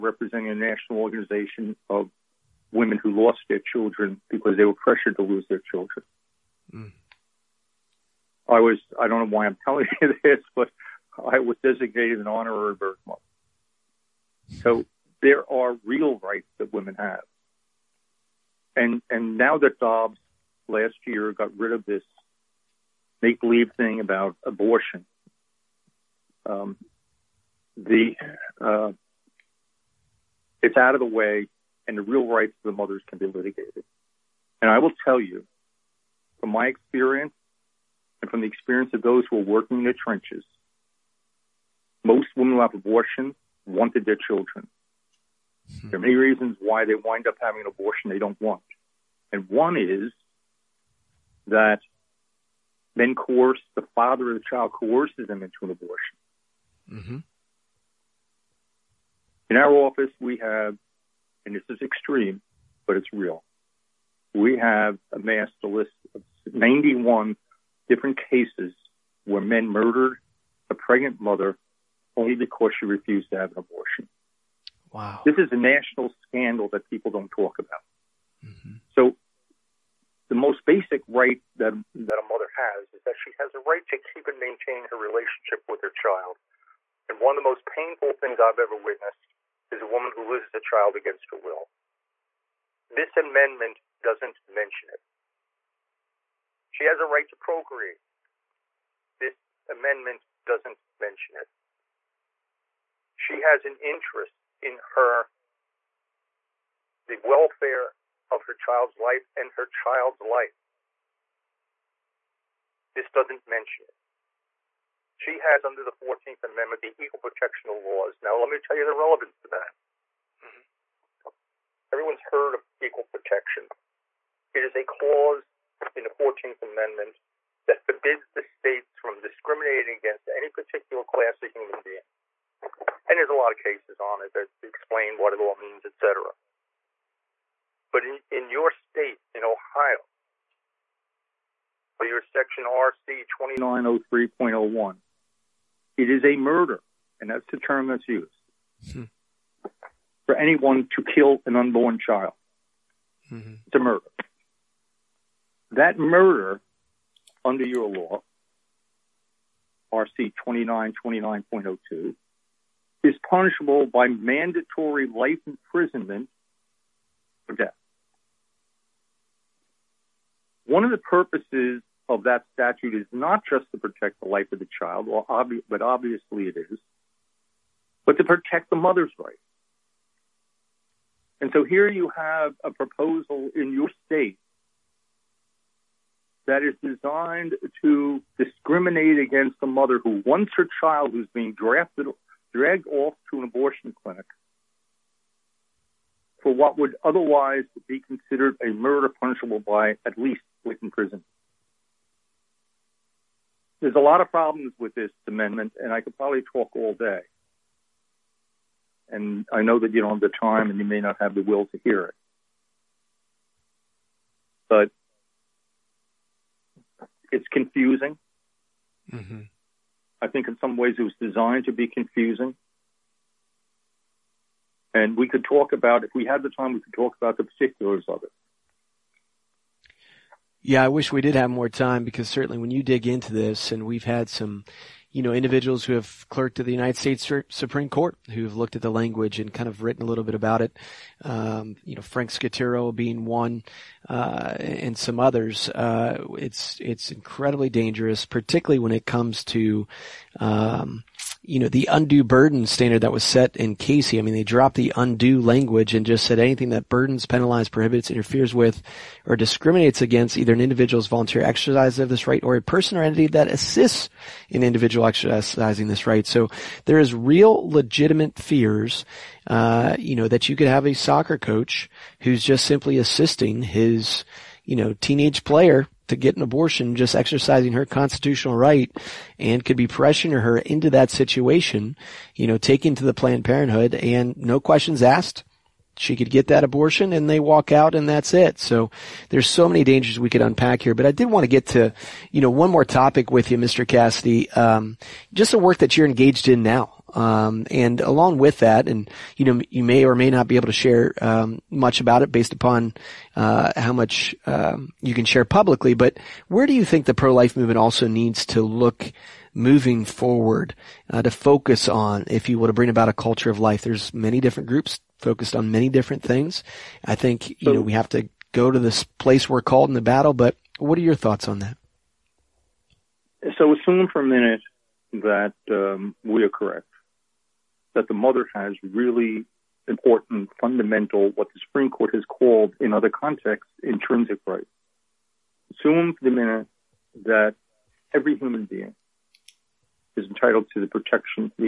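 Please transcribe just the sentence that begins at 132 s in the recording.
And there's a lot of cases on it that explain what it all means, et cetera.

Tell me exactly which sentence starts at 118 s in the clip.
Now, let me tell you the relevance to that.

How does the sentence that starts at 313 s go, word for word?
There's many different groups focused on many different things.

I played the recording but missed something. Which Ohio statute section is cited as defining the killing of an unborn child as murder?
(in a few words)
RC 2903.01.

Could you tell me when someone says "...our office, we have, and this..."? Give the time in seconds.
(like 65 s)
59 s.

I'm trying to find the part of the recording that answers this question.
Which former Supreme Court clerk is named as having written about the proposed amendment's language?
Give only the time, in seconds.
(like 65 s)
242 s.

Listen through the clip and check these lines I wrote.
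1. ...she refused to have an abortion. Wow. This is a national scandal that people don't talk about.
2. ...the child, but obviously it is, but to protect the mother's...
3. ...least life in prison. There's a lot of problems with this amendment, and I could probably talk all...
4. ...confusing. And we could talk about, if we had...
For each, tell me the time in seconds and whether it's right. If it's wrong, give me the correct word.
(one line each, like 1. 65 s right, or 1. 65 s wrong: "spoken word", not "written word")
1. 72 s right
2. 174 s right
3. 200 s right
4. 221 s right.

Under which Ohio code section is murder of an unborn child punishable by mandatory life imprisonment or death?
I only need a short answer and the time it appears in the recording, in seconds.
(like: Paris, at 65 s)
RC 2929.02, at 159 s.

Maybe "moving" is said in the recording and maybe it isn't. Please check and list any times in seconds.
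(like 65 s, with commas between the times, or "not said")
309 s.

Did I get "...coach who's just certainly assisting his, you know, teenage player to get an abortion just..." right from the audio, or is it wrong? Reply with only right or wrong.
wrong.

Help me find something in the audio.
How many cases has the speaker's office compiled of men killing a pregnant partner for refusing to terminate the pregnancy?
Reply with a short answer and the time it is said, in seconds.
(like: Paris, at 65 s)
91, at 66 s.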